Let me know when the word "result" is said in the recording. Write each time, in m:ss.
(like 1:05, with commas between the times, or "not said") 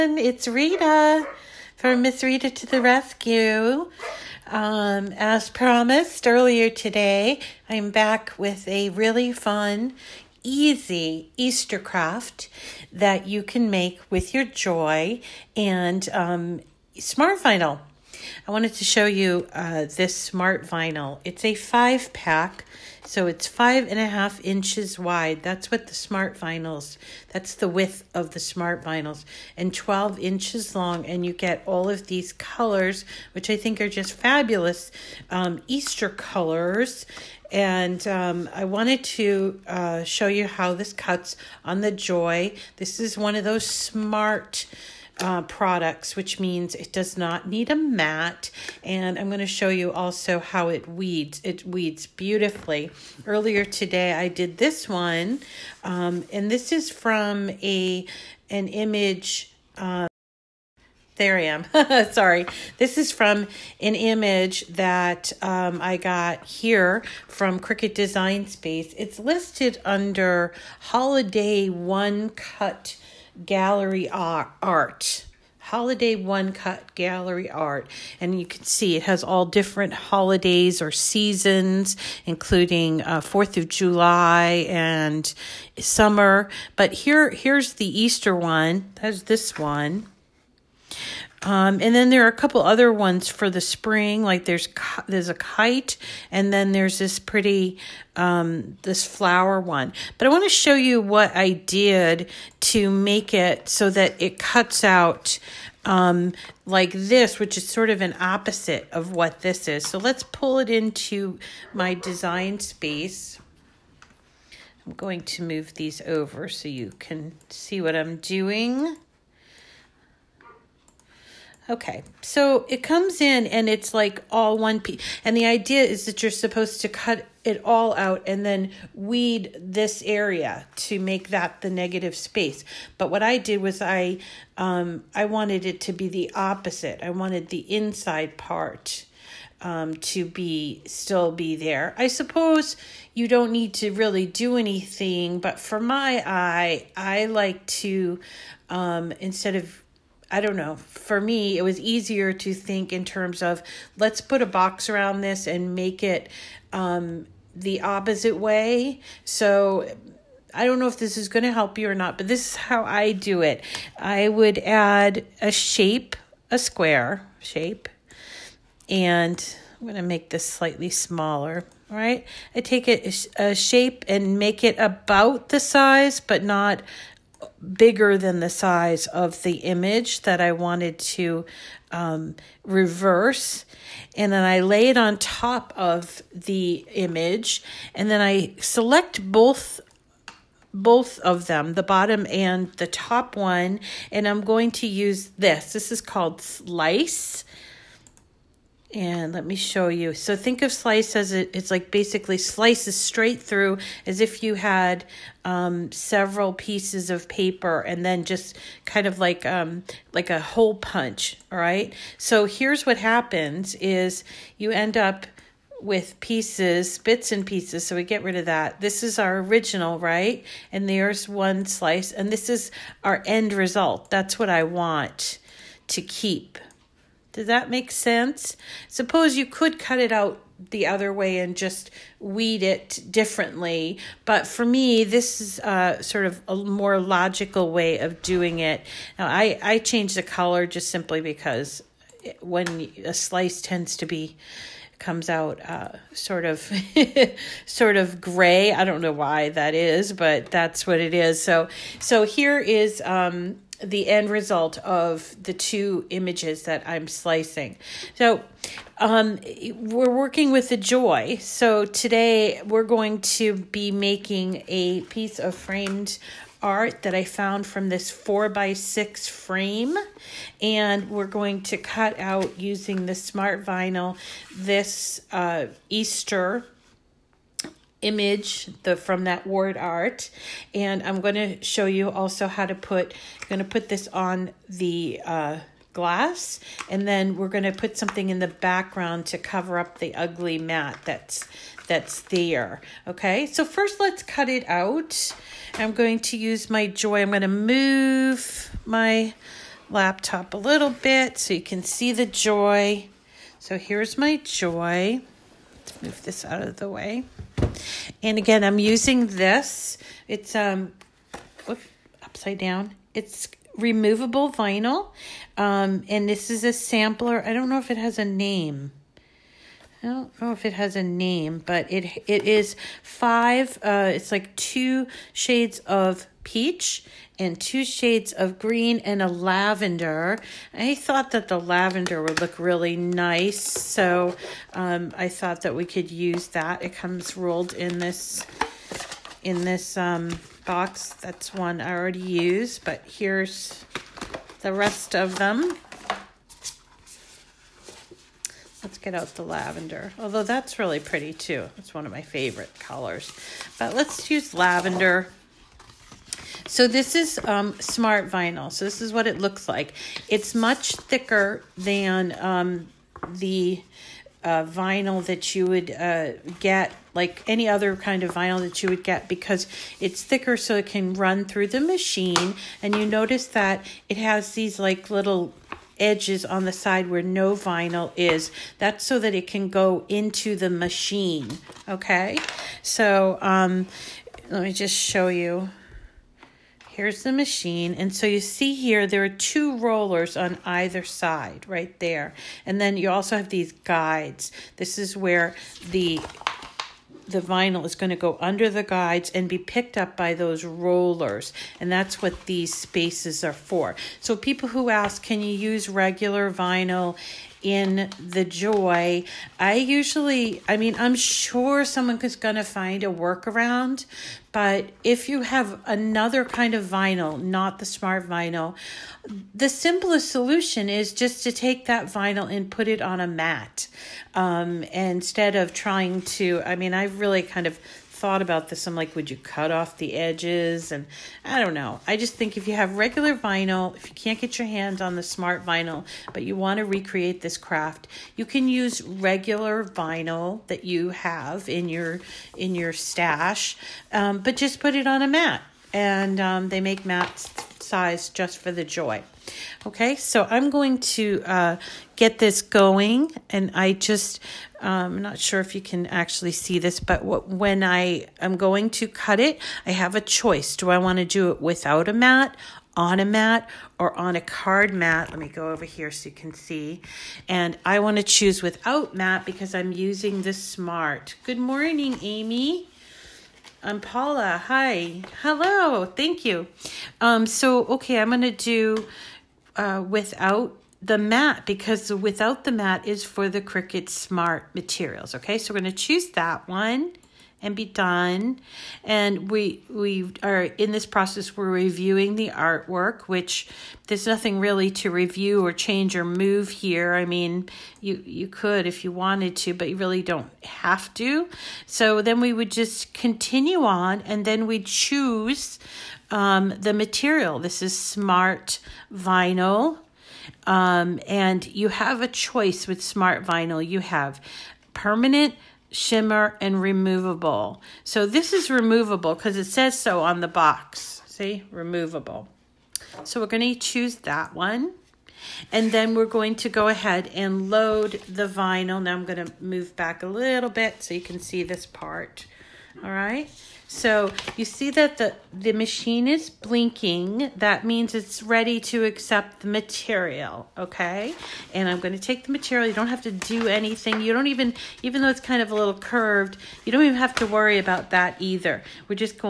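3:43, 4:14.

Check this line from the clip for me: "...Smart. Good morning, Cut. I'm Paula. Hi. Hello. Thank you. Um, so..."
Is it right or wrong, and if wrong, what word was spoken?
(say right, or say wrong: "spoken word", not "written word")
wrong: "Amy", not "Cut".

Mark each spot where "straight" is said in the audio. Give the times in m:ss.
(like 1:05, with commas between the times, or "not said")
3:22.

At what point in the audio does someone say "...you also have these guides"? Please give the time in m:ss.
6:32.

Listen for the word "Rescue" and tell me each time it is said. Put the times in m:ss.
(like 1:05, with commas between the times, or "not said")
0:02.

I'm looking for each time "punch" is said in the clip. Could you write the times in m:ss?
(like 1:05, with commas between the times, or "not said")
3:30.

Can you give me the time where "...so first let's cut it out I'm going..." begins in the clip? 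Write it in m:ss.
4:53.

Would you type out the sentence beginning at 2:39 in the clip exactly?
So I don't know if this is going to help you or not, but this is how I do it.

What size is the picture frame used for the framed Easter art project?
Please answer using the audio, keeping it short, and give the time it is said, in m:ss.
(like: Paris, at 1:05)
4 by 6, at 4:28.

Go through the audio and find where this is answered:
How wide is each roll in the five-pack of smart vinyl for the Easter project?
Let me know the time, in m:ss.
0:23.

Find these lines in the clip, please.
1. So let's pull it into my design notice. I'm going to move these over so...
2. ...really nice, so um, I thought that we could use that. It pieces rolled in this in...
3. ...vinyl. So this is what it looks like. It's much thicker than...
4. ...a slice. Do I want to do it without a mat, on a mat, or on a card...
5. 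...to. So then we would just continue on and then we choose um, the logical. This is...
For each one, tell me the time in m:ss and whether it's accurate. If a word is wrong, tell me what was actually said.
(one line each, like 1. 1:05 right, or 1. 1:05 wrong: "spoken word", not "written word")
1. 1:49 wrong: "space", not "notice"
2. 5:32 wrong: "comes", not "pieces"
3. 5:58 right
4. 7:40 wrong: "choice", not "slice"
5. 8:21 wrong: "material", not "logical".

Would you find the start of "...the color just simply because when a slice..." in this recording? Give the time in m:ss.
4:00.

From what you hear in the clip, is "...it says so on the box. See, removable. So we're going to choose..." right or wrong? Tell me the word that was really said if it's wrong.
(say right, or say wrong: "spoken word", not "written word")
right.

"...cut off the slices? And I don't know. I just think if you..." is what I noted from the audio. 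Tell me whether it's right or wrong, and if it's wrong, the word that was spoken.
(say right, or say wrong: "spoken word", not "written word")
wrong: "edges", not "slices".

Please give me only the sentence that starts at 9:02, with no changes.
You don't have to do anything.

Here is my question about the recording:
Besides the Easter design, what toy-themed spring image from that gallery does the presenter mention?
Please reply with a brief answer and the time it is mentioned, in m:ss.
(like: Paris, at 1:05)
kite, at 1:35.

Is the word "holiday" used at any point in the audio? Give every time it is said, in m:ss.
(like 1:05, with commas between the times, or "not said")
1:10, 1:15, 1:19.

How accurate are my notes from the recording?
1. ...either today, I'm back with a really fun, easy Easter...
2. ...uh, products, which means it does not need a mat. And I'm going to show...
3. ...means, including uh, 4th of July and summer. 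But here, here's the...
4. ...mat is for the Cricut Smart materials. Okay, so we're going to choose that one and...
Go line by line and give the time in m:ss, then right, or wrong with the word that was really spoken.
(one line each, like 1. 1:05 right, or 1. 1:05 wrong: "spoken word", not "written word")
1. 0:06 wrong: "earlier", not "either"
2. 0:45 right
3. 1:20 wrong: "seasons", not "means"
4. 8:02 right.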